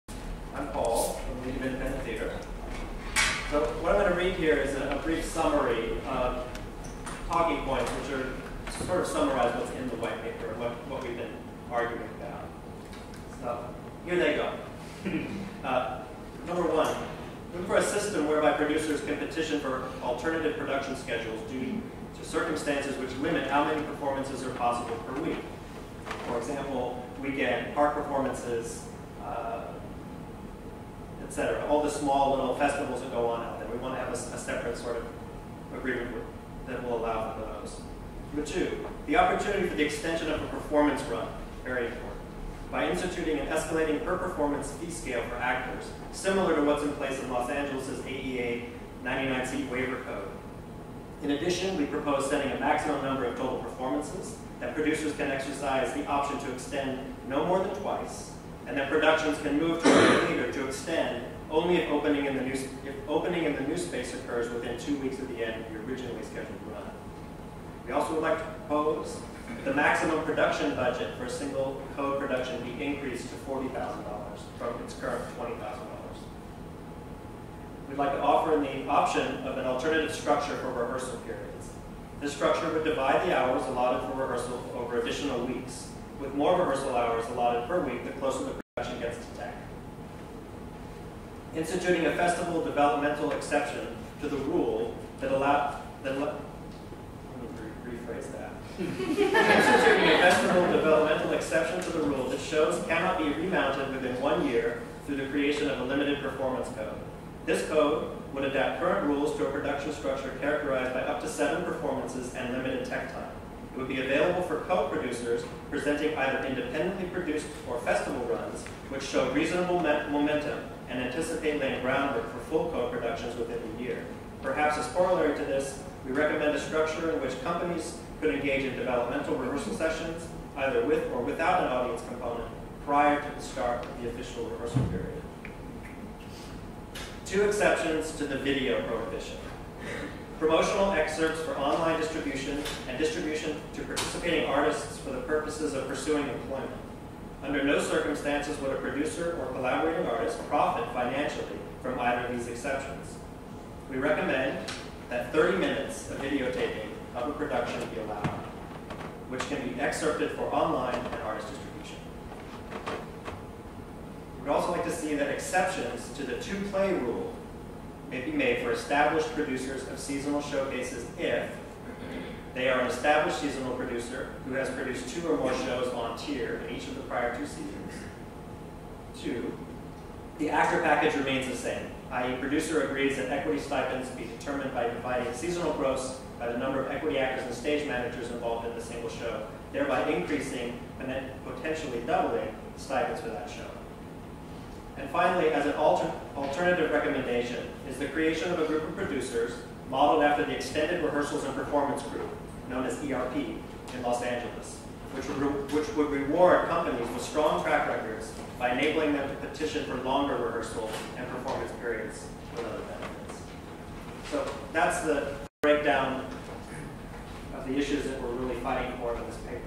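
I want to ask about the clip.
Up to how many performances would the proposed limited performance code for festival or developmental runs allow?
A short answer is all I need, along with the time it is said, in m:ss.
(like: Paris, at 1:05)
7, at 1:51.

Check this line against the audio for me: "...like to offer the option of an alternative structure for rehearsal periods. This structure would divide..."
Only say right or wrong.
right.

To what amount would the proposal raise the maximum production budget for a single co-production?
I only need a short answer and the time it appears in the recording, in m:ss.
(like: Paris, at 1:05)
$40,000, at 1:13.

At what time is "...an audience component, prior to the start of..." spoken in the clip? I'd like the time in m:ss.
2:11.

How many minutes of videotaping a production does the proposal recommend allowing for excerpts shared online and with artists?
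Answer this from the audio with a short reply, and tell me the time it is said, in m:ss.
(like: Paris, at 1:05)
30, at 2:35.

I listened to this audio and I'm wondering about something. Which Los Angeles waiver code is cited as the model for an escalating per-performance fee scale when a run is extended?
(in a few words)
AEA 99C.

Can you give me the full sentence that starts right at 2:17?
Two exceptions to the video prohibition promotional excerpts for online distribution and distribution to participating artists for the purposes of pursuing employment.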